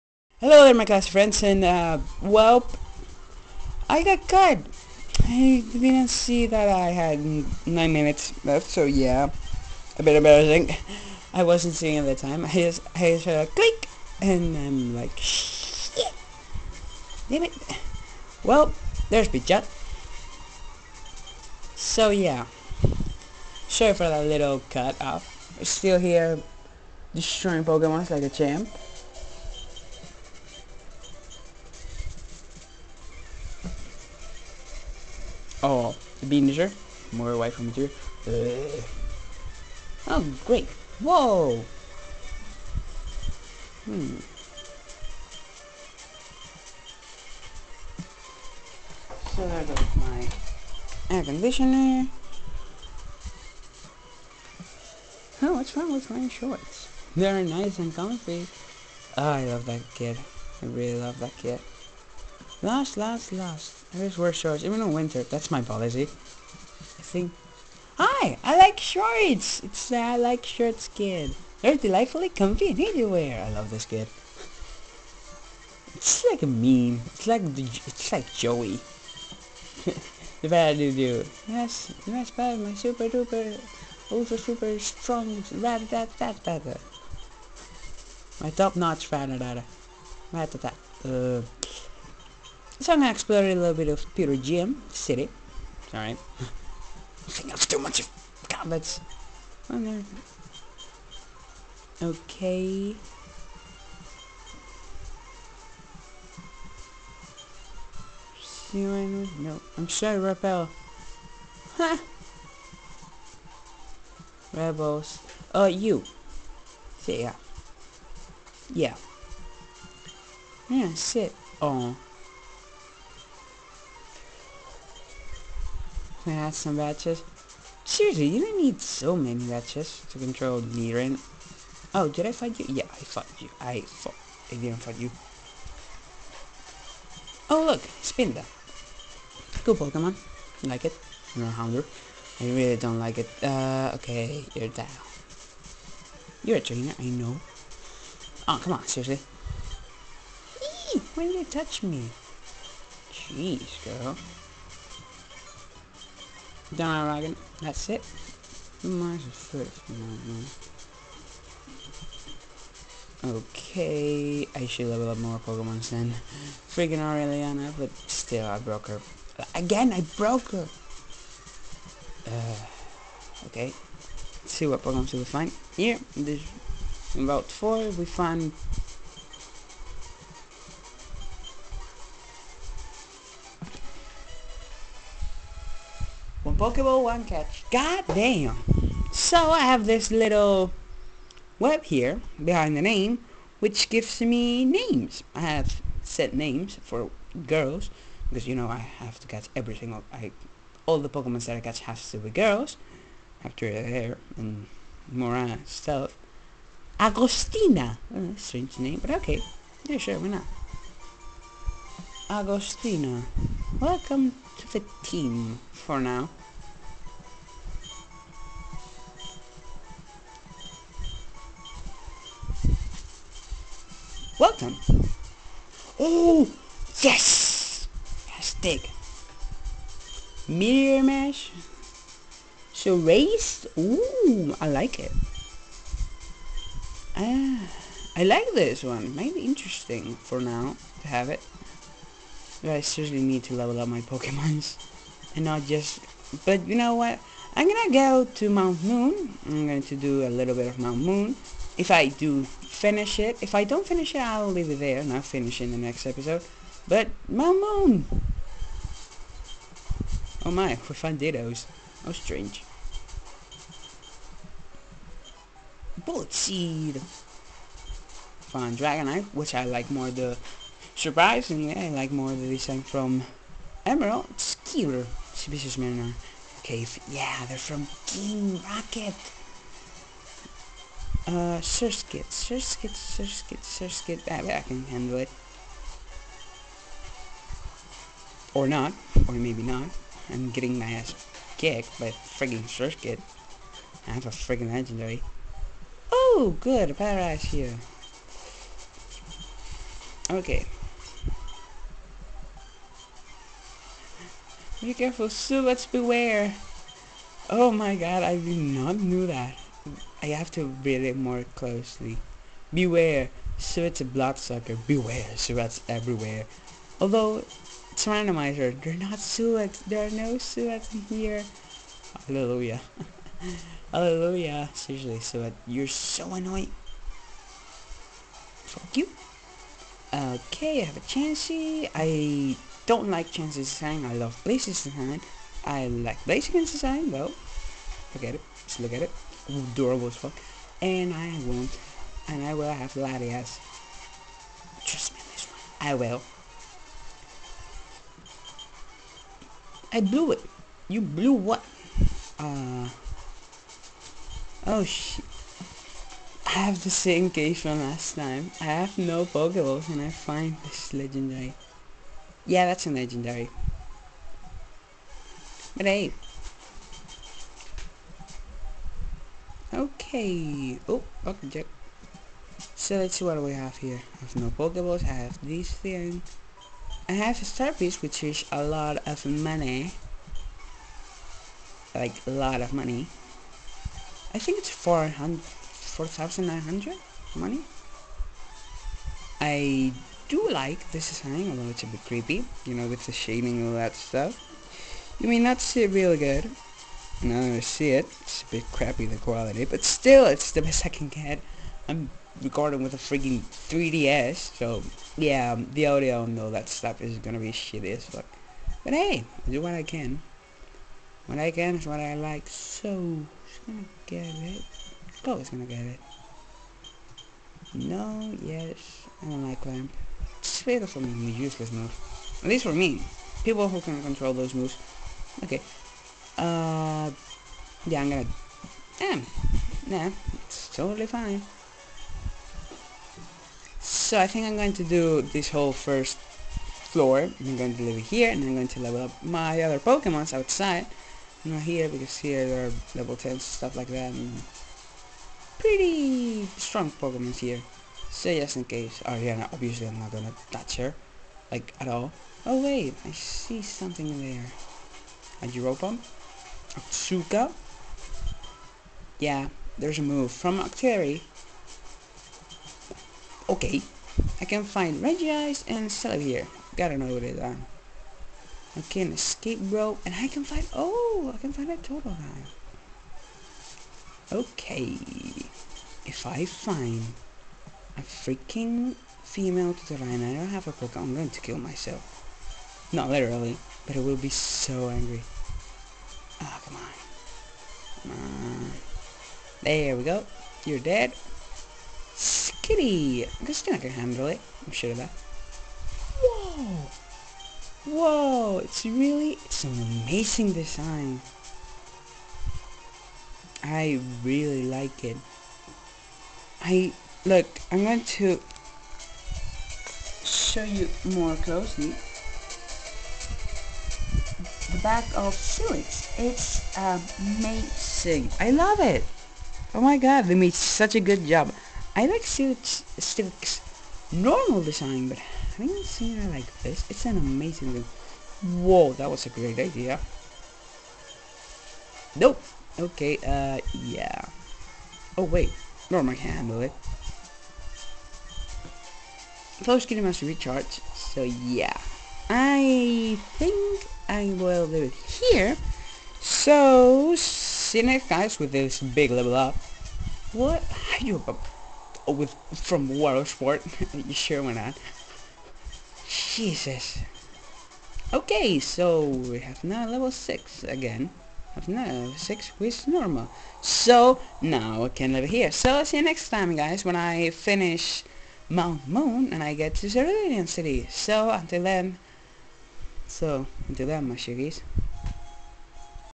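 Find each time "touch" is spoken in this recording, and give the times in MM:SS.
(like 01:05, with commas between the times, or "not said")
02:31, 07:30.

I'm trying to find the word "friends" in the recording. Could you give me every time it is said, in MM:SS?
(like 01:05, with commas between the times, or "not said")
00:01.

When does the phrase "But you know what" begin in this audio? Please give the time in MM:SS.
04:06.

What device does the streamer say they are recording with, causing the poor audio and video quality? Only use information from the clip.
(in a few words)
3DS.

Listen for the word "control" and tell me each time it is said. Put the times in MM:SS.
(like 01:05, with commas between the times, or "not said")
02:10, 07:04.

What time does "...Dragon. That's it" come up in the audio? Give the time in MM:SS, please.
02:37.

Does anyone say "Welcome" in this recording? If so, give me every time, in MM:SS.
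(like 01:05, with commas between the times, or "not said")
03:33, 03:44.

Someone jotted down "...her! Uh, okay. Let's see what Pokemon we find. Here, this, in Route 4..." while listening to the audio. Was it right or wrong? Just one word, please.
right.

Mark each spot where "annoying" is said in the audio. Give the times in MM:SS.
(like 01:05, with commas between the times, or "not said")
05:26.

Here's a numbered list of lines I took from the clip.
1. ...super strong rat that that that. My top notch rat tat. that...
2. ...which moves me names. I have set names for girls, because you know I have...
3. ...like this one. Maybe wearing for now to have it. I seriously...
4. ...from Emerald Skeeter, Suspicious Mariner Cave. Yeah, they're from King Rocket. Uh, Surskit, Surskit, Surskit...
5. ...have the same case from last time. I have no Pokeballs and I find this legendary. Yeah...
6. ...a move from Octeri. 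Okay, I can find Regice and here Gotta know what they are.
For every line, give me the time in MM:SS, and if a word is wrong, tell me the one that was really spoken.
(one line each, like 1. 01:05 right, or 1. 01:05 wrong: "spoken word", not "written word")
1. 01:24 right
2. 03:13 wrong: "gives", not "moves"
3. 03:58 wrong: "interesting", not "wearing"
4. 04:32 right
5. 05:56 right
6. 07:39 right.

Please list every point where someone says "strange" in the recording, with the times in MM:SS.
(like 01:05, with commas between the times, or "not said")
03:28, 04:22.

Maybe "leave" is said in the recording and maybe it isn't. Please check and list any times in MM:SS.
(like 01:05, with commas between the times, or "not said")
04:14, 07:17, 09:04.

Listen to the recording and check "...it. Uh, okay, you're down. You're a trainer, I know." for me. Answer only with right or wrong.
right.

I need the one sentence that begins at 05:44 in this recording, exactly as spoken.
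Trust me on this one, I will.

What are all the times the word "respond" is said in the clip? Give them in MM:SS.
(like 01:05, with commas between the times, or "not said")
not said.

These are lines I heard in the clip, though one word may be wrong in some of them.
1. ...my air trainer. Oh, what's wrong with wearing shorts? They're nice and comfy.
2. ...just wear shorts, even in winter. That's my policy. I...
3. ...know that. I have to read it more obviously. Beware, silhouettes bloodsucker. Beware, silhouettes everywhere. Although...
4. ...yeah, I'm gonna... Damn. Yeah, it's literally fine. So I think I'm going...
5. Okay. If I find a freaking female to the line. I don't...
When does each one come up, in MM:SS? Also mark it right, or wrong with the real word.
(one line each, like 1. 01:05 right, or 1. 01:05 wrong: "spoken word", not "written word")
1. 00:49 wrong: "conditioner", not "trainer"
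2. 01:03 right
3. 05:08 wrong: "closely", not "obviously"
4. 07:07 wrong: "totally", not "literally"
5. 07:54 right.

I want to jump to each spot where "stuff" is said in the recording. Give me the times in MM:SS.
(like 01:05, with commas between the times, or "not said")
03:25, 06:33, 06:46, 07:23.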